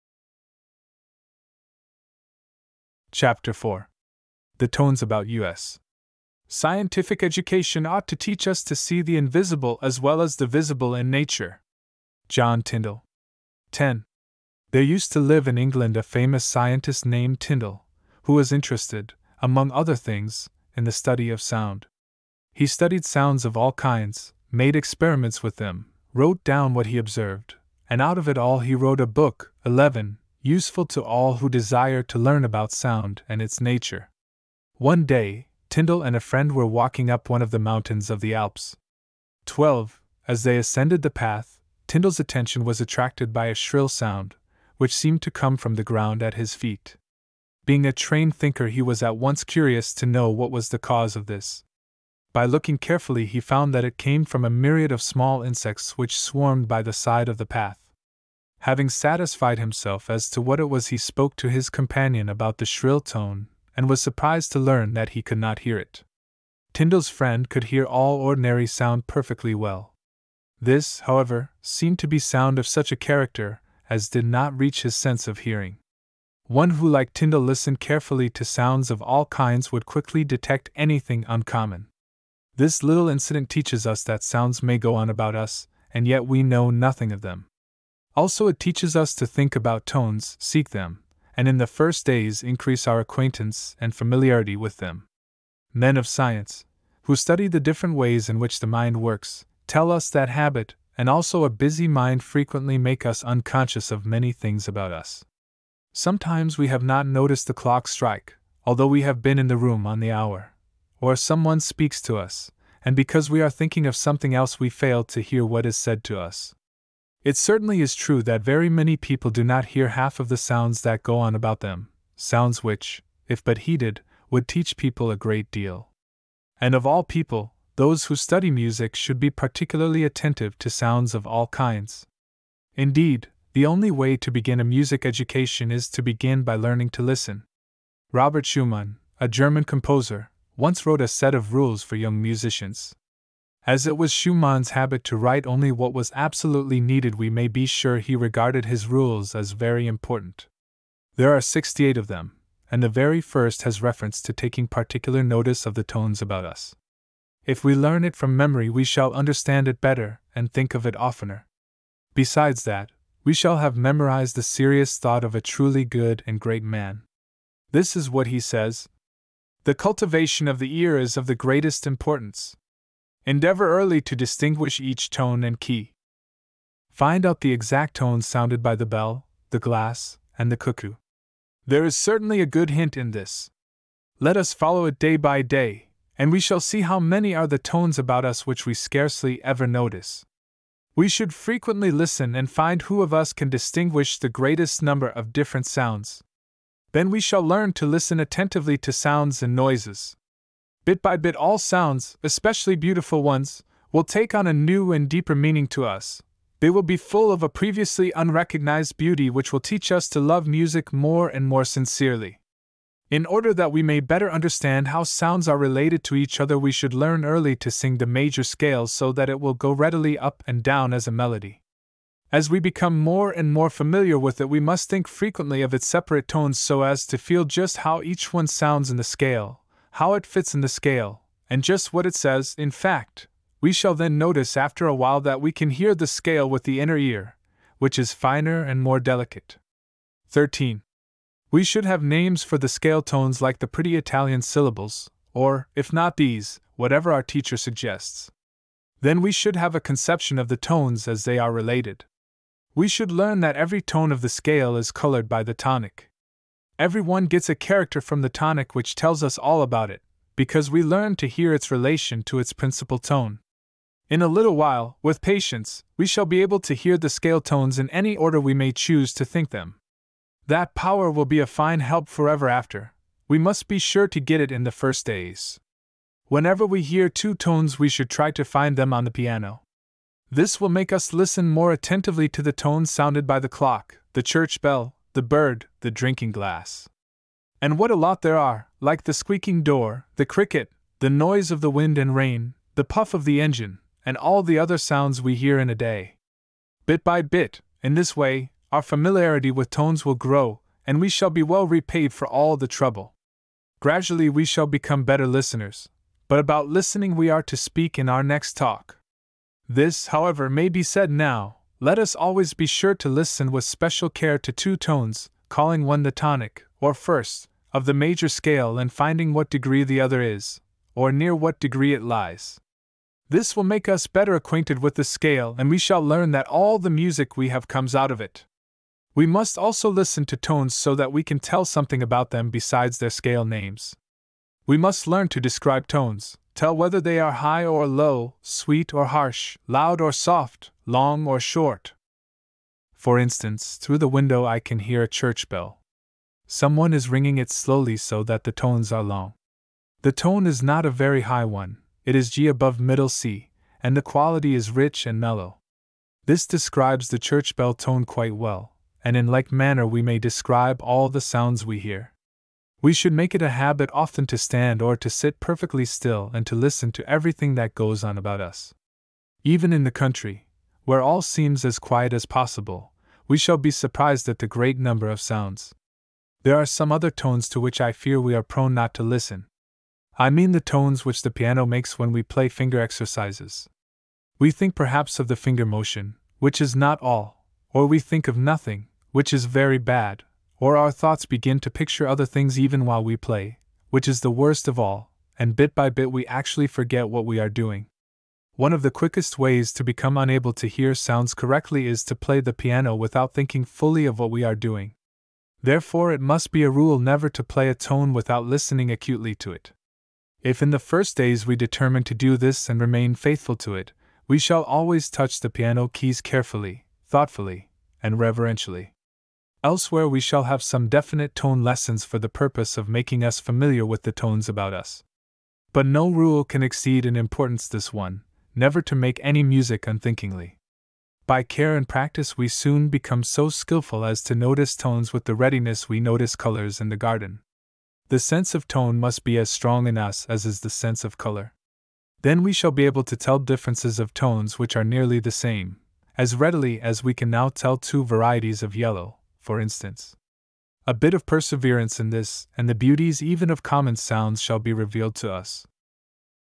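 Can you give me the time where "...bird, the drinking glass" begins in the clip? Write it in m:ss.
4:45.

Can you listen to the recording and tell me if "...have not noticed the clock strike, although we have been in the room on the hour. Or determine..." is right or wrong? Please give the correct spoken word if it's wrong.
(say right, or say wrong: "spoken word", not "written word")
wrong: "someone", not "determine".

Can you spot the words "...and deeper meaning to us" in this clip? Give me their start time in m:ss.
3:24.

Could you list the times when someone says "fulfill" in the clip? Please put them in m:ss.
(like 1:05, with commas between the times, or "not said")
not said.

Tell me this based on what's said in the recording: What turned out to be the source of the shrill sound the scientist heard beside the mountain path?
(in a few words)
small insects.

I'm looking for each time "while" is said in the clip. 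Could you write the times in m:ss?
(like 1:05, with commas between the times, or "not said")
3:54, 4:24, 6:32.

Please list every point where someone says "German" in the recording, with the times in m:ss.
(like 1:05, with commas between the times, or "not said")
2:19.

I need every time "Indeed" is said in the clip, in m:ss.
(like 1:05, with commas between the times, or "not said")
2:12.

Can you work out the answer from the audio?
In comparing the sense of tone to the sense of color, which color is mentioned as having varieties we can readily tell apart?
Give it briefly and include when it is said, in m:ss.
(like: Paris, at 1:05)
yellow, at 7:28.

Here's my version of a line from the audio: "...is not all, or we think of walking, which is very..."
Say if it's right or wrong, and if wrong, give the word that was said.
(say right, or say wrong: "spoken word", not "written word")
wrong: "nothing", not "walking".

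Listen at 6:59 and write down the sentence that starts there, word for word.
Elsewhere, we shall have some definite tone lessons for the purpose of making us familiar with the tones about us.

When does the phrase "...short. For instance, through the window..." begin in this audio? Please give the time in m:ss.
5:41.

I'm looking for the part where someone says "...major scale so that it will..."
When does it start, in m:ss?
3:38.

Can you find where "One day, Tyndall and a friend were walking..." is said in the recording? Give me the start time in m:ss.
0:34.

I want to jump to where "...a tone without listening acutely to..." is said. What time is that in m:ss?
6:47.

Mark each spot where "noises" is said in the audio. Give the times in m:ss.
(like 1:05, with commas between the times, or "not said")
3:19, 4:51.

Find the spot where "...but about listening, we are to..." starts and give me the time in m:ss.
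5:06.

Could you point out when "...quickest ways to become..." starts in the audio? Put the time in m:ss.
6:38.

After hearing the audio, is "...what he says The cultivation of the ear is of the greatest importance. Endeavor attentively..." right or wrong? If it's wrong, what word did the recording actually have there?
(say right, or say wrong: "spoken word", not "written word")
wrong: "early", not "attentively".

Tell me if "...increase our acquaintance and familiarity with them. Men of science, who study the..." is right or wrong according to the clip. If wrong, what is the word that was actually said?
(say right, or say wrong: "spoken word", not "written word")
right.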